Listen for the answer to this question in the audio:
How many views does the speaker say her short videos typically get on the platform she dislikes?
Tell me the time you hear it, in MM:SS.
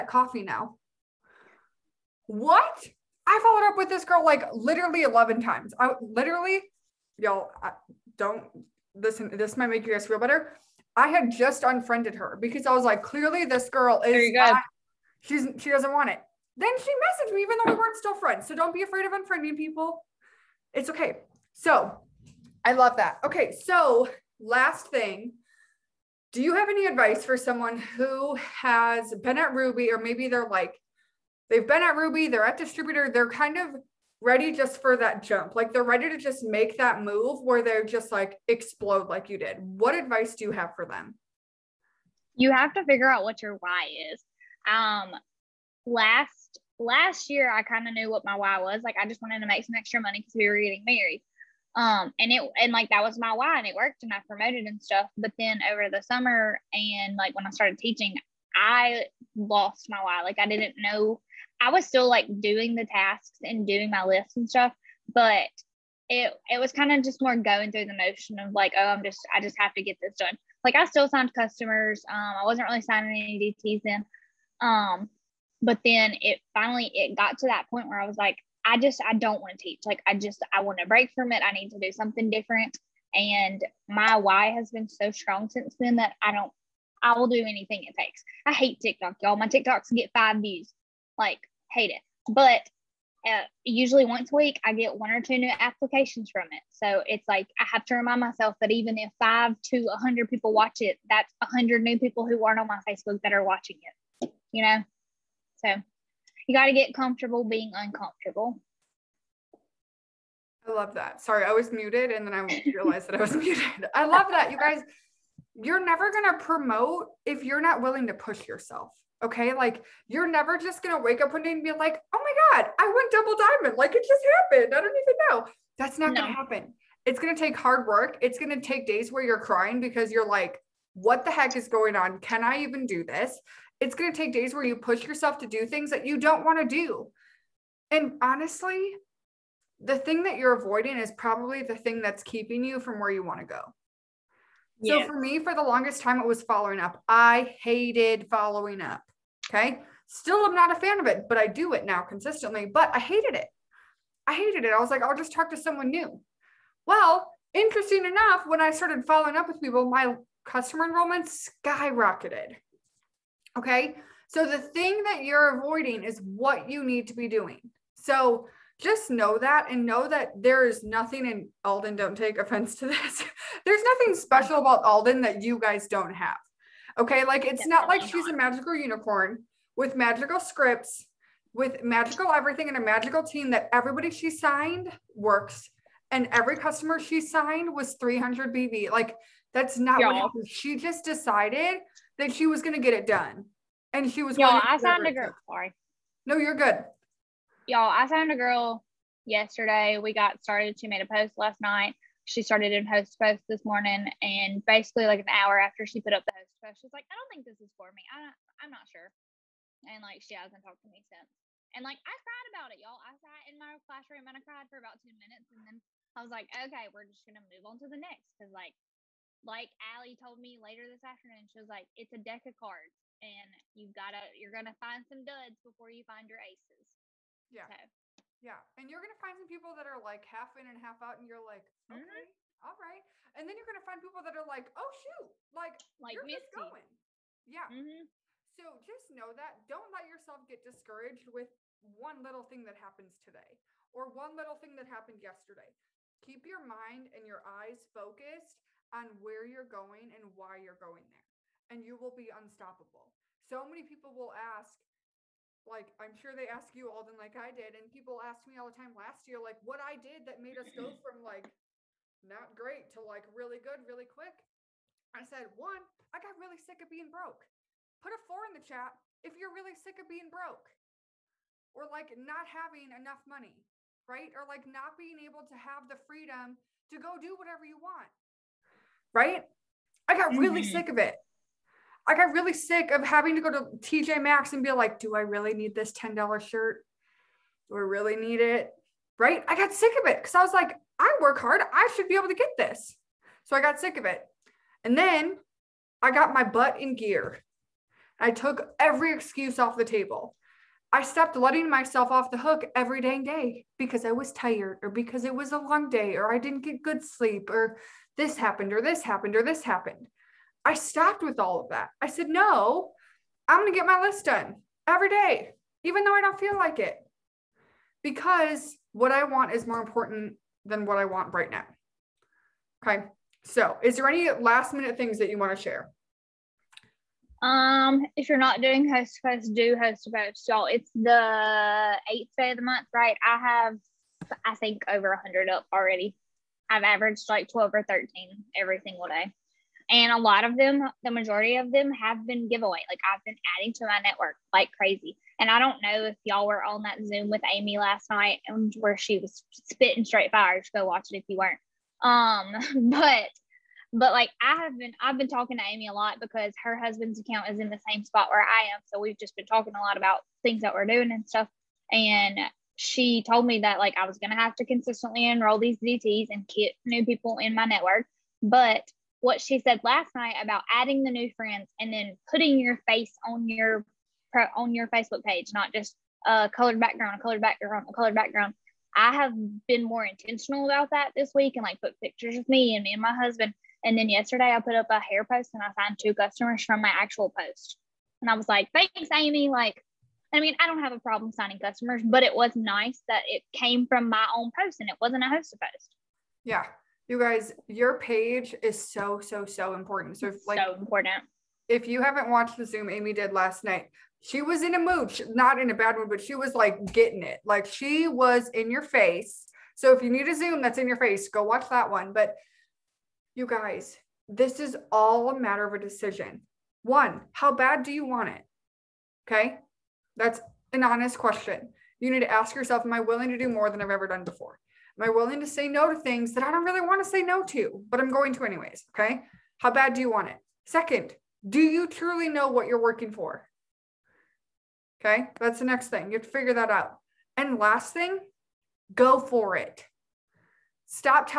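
01:30.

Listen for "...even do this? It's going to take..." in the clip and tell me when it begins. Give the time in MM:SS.
02:12.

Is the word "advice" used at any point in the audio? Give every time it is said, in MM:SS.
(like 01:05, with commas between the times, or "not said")
00:26, 00:39.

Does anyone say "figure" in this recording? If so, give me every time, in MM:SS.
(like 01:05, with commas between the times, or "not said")
00:42, 07:16.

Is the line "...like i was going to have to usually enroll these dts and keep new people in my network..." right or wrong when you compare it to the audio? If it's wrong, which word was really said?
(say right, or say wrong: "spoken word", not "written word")
wrong: "consistently", not "usually".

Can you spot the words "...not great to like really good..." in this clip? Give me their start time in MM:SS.
04:22.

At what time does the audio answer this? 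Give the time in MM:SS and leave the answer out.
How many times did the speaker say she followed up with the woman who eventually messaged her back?
00:05.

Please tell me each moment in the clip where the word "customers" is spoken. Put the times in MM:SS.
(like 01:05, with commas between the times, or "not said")
01:11, 02:40, 03:06, 06:26, 06:31.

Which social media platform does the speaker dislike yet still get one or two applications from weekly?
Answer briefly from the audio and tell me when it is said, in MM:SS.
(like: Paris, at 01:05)
TikTok, at 01:28.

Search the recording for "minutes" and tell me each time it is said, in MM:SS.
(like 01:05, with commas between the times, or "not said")
03:35, 05:24.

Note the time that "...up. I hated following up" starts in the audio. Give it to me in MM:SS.
02:26.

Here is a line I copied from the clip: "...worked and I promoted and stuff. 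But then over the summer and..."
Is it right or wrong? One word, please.
right.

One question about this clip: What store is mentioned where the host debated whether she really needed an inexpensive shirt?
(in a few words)
TJ Maxx.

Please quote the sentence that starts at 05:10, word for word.
I stopped with all of that.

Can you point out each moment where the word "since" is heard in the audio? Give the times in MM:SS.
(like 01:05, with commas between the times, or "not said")
01:25, 03:31.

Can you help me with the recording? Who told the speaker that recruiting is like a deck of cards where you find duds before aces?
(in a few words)
Allie.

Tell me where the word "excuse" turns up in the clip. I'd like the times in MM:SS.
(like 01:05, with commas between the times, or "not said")
04:59.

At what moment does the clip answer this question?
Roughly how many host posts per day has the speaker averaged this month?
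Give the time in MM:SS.
05:37.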